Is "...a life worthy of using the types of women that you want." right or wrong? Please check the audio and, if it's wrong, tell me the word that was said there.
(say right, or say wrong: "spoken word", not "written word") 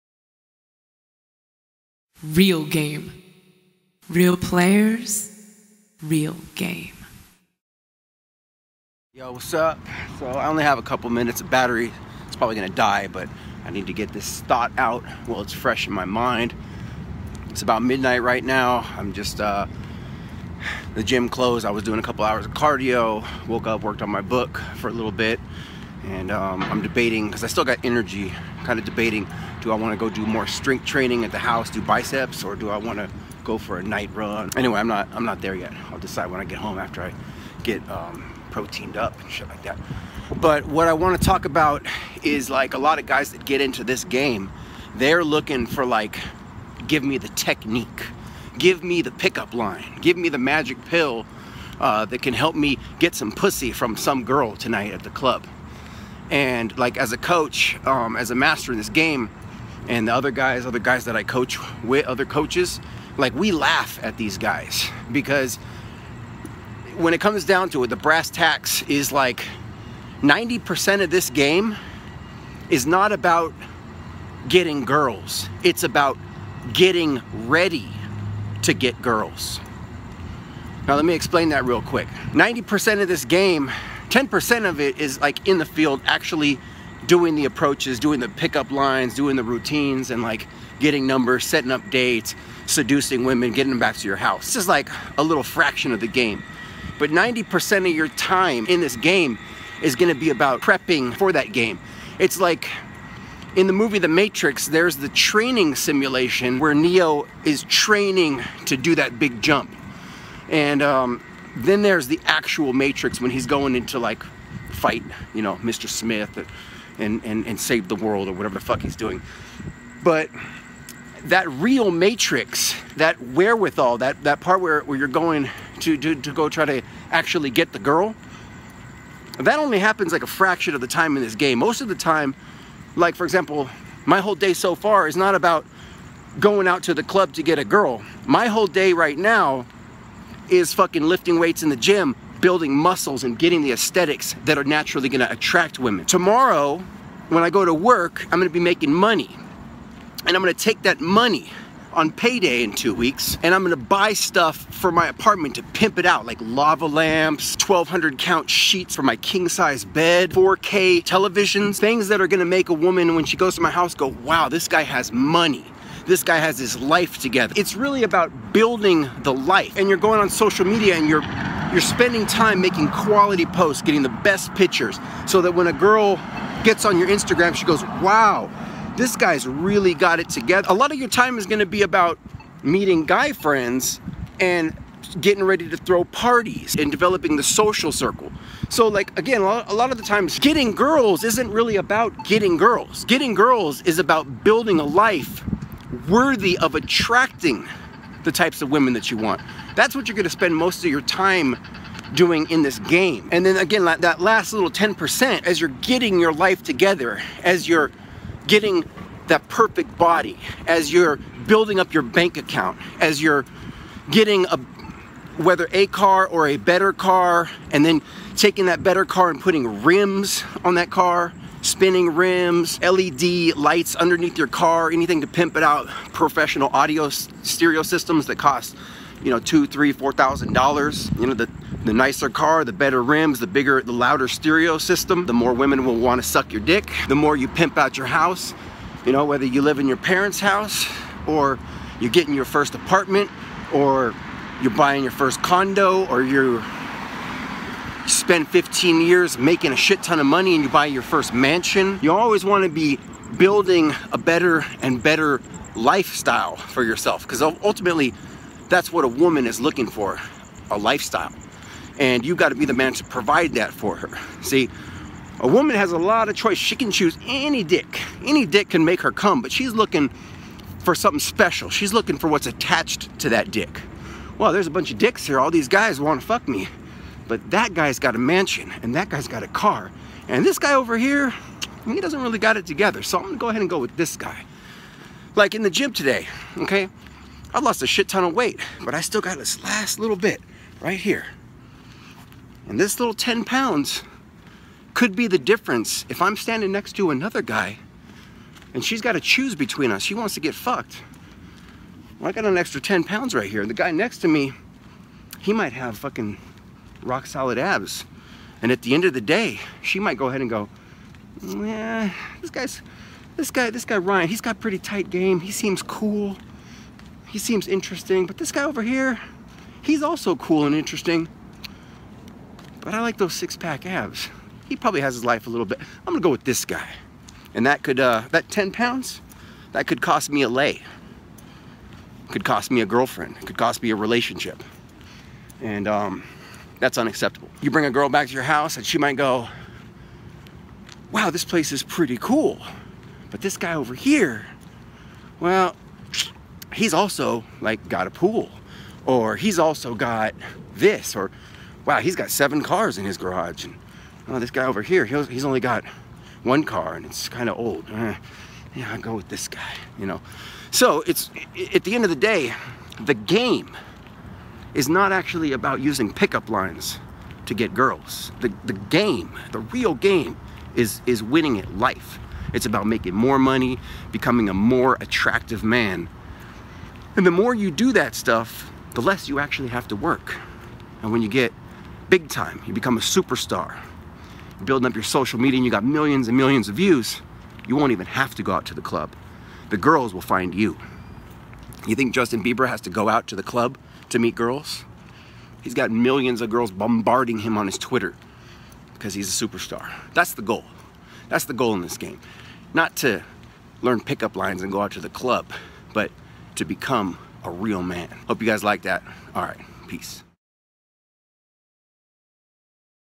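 wrong: "attracting", not "using".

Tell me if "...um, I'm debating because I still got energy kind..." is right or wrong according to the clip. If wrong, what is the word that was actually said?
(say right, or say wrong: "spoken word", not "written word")
right.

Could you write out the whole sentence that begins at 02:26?
Tomorrow, when I go to work, I'm gonna be making money.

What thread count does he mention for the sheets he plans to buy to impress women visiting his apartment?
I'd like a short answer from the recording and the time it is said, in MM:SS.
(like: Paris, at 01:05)
1200, at 02:37.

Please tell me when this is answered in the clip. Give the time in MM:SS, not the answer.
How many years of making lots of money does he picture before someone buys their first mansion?
04:08.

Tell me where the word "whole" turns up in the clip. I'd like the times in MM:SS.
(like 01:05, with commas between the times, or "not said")
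02:14, 02:18.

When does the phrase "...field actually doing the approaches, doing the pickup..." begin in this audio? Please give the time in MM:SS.
01:25.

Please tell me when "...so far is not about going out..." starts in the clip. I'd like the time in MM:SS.
02:14.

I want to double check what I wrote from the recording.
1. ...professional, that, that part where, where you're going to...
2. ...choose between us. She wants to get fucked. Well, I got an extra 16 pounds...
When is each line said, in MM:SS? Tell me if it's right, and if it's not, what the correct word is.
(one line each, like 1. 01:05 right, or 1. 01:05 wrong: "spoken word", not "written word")
1. 02:03 wrong: "wherewithal", not "professional"
2. 04:59 wrong: "10", not "16".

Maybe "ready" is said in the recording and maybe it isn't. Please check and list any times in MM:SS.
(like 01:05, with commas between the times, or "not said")
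01:17, 03:05.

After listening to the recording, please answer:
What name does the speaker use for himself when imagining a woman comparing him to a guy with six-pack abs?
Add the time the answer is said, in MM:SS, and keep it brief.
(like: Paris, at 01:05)
Ryan, at 05:13.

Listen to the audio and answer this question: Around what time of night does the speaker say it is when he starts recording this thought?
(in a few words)
midnight.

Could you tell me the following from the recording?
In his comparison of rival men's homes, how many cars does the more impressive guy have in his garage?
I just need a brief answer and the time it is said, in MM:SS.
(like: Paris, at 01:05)
7, at 05:52.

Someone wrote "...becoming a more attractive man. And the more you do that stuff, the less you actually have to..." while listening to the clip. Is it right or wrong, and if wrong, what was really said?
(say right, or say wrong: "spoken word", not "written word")
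right.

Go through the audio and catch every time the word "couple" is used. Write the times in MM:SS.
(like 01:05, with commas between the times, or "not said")
00:10, 00:22.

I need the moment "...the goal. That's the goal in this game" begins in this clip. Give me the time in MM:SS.
06:40.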